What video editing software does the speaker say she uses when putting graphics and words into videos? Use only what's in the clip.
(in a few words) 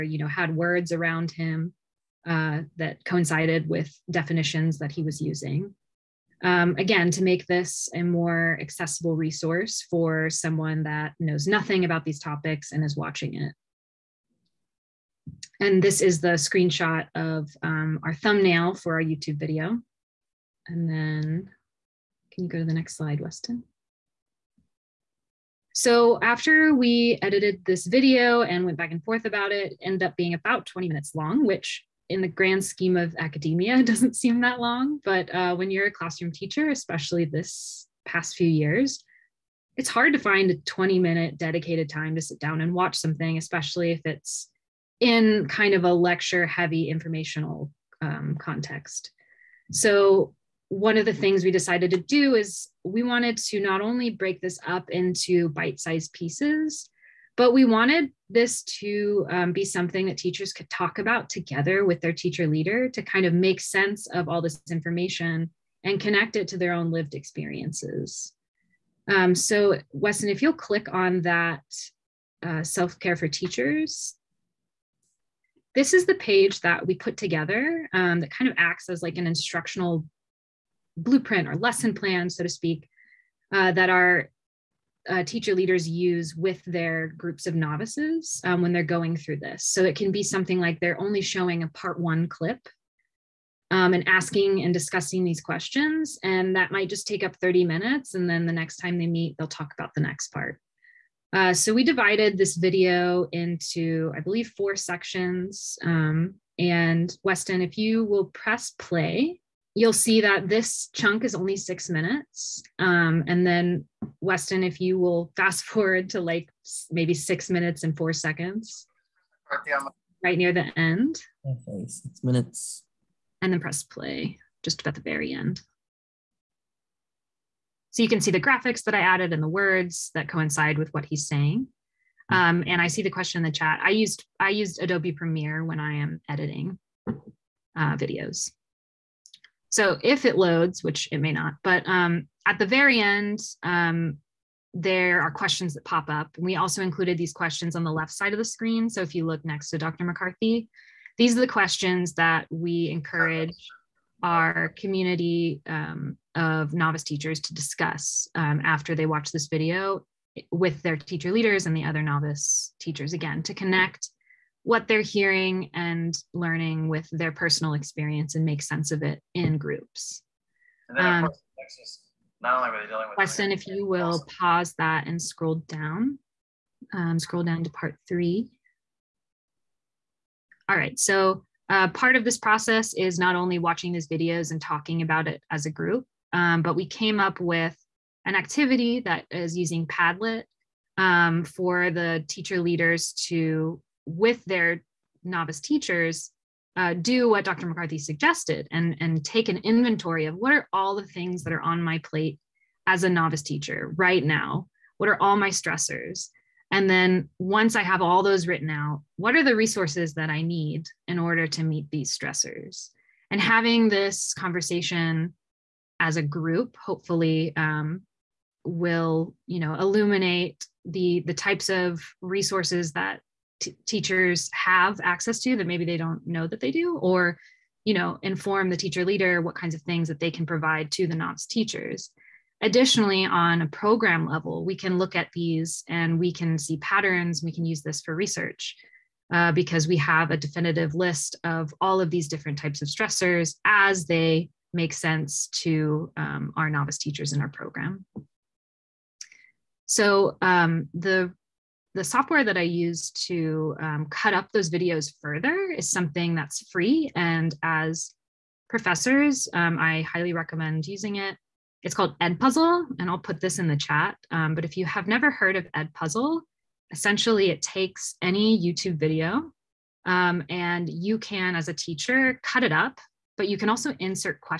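Adobe Premiere.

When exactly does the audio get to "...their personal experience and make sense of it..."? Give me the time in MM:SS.
02:47.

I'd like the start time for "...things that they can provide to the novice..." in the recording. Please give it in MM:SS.
03:49.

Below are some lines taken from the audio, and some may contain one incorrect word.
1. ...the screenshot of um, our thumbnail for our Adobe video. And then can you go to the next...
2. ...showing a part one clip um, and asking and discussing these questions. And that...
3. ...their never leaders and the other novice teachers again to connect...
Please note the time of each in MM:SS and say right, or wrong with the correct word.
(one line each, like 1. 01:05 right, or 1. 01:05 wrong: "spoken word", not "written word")
1. 00:16 wrong: "YouTube", not "Adobe"
2. 01:31 right
3. 02:40 wrong: "teacher", not "never".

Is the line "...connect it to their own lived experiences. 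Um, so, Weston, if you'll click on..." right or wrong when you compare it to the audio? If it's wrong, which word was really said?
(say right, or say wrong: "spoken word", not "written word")
right.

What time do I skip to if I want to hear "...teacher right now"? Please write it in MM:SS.
03:23.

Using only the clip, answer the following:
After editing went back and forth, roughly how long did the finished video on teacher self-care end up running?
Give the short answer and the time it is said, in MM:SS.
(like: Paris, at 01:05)
20 minutes, at 00:30.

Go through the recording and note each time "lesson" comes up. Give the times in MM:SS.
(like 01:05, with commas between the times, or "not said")
01:21.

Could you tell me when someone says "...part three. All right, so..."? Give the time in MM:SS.
02:57.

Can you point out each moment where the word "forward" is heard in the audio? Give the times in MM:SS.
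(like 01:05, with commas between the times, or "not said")
01:55.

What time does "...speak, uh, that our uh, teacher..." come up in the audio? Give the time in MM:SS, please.
01:22.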